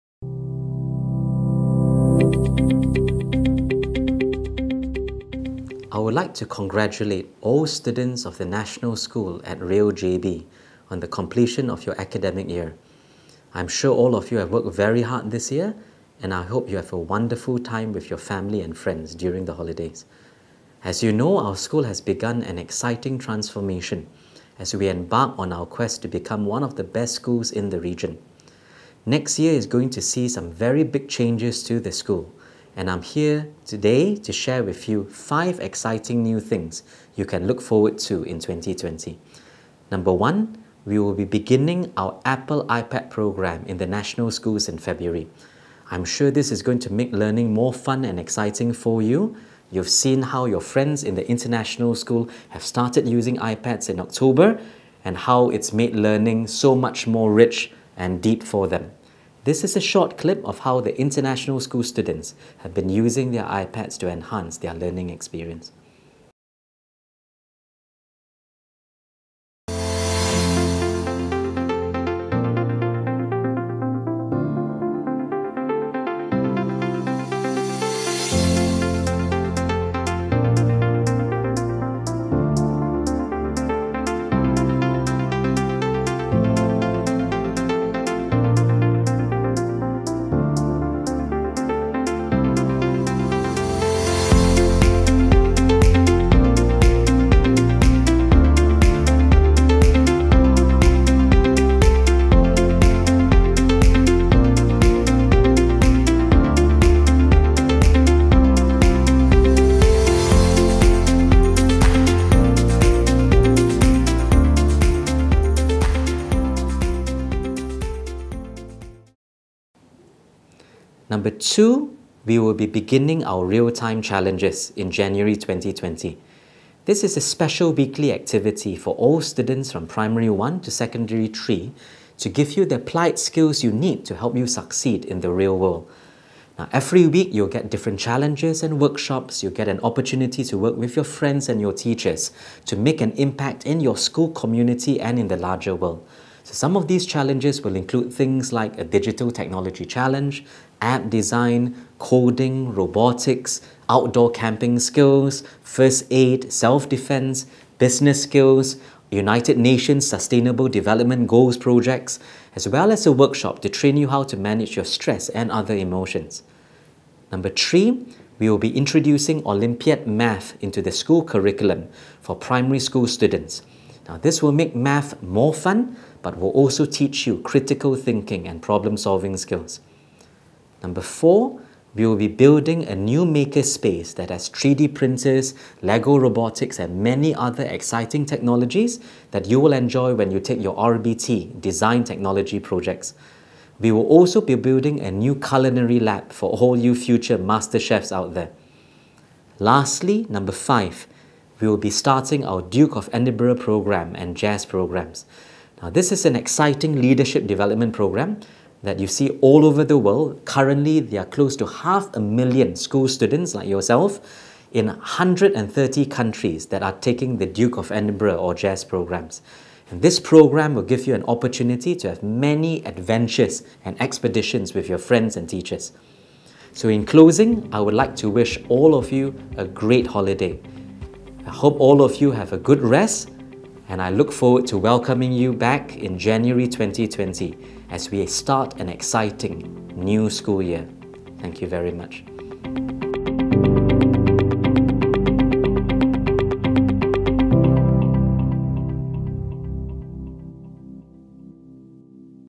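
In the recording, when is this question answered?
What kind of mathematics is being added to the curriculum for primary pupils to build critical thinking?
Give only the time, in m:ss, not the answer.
2:49.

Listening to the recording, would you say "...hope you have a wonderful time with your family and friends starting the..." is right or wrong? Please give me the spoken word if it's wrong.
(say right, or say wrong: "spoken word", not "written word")
wrong: "during", not "starting".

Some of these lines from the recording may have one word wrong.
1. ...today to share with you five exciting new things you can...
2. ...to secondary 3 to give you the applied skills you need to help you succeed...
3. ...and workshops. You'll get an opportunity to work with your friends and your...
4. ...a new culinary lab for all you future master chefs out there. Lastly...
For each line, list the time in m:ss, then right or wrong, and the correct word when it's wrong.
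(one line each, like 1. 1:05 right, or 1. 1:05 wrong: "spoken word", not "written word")
1. 0:33 right
2. 2:10 right
3. 2:18 right
4. 3:14 right.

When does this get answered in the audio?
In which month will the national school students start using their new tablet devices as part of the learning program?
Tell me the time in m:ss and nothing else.
0:44.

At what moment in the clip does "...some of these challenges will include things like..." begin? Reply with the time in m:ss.
2:26.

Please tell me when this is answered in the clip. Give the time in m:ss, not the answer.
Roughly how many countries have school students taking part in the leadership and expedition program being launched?
3:34.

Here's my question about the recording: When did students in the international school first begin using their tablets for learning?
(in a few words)
October.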